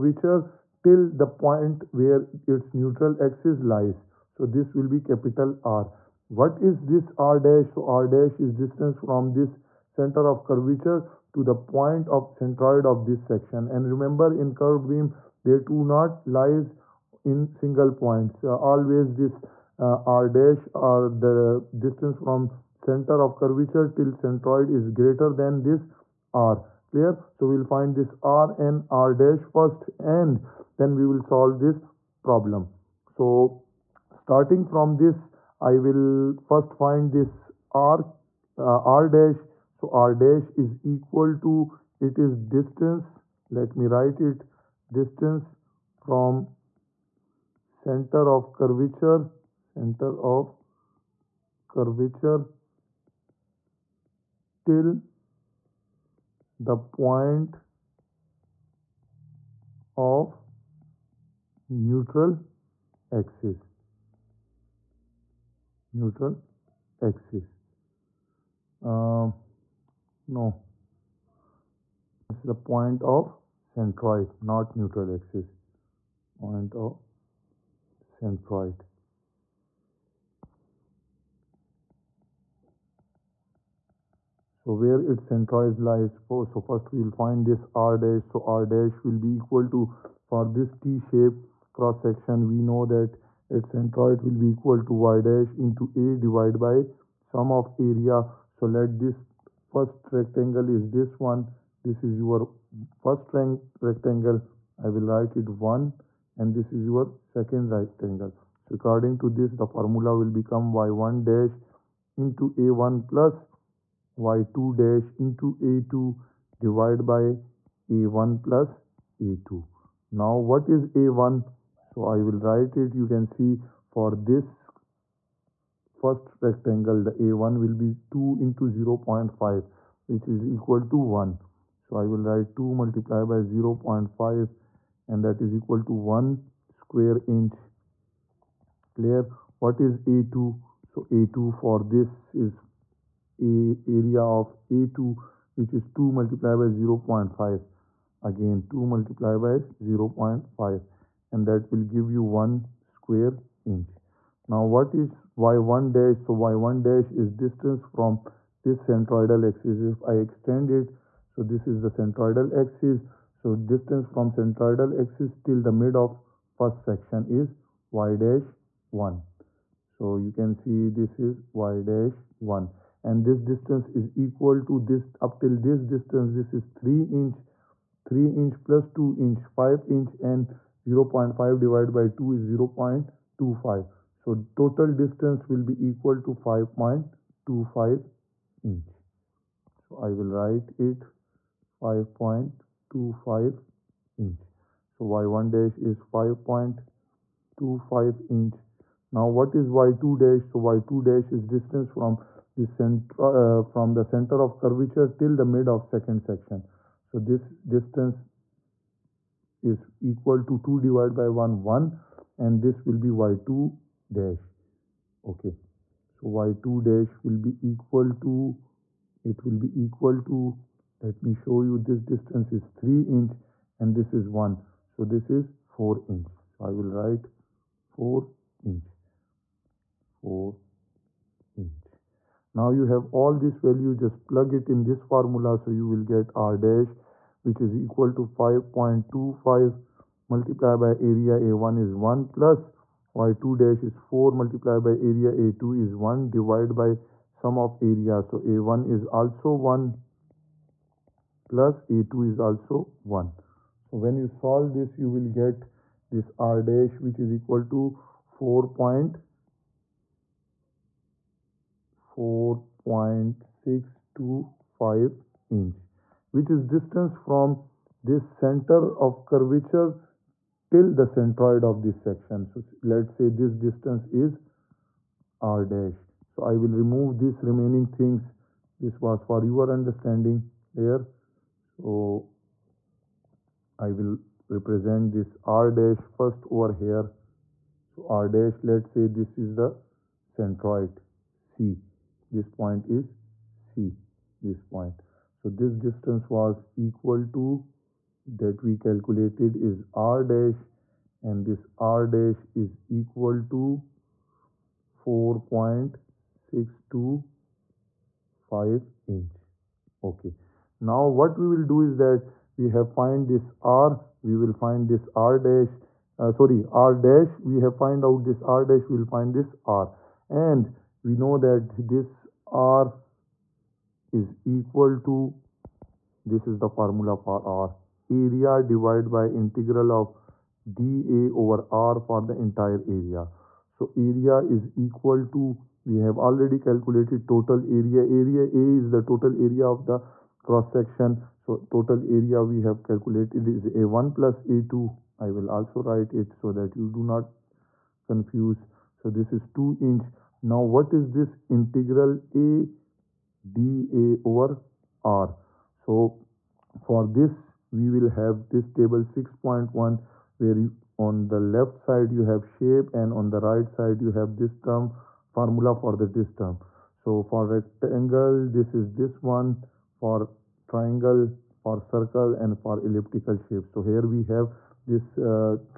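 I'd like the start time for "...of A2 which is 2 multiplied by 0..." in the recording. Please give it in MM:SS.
02:24.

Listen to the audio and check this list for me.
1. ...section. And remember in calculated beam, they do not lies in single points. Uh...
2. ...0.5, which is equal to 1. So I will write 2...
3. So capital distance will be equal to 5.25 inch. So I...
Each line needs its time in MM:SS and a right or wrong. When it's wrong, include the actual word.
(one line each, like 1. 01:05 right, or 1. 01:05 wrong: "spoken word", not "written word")
1. 00:13 wrong: "curved", not "calculated"
2. 02:09 right
3. 03:04 wrong: "total", not "capital".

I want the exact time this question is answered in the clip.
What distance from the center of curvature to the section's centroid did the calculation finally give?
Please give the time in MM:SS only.
05:05.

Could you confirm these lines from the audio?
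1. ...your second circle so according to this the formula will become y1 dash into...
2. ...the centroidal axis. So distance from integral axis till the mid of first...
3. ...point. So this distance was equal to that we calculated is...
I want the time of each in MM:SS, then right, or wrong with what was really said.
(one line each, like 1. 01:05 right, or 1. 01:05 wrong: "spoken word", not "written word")
1. 01:46 wrong: "rectangle", not "circle"
2. 02:41 wrong: "centroidal", not "integral"
3. 04:54 right.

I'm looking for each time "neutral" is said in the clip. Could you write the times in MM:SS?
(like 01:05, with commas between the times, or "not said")
00:02, 01:01, 01:05, 01:14.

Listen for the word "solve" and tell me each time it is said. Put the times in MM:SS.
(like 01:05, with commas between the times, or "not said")
00:31, 04:14.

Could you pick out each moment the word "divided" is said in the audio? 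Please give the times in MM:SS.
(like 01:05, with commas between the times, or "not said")
01:36, 01:56, 03:01, 03:30, 04:06, 05:28.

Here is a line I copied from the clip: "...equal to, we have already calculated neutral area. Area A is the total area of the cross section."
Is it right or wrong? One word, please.
wrong.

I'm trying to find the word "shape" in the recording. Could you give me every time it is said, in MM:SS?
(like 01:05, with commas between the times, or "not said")
01:30, 06:02, 06:13.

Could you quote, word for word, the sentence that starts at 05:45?
I will also write it so that you do not confuse.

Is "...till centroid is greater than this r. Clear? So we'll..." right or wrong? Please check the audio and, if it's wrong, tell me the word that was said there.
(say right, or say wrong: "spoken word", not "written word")
right.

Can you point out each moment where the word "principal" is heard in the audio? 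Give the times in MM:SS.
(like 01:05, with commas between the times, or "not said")
not said.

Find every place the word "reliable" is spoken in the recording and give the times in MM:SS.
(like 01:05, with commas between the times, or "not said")
not said.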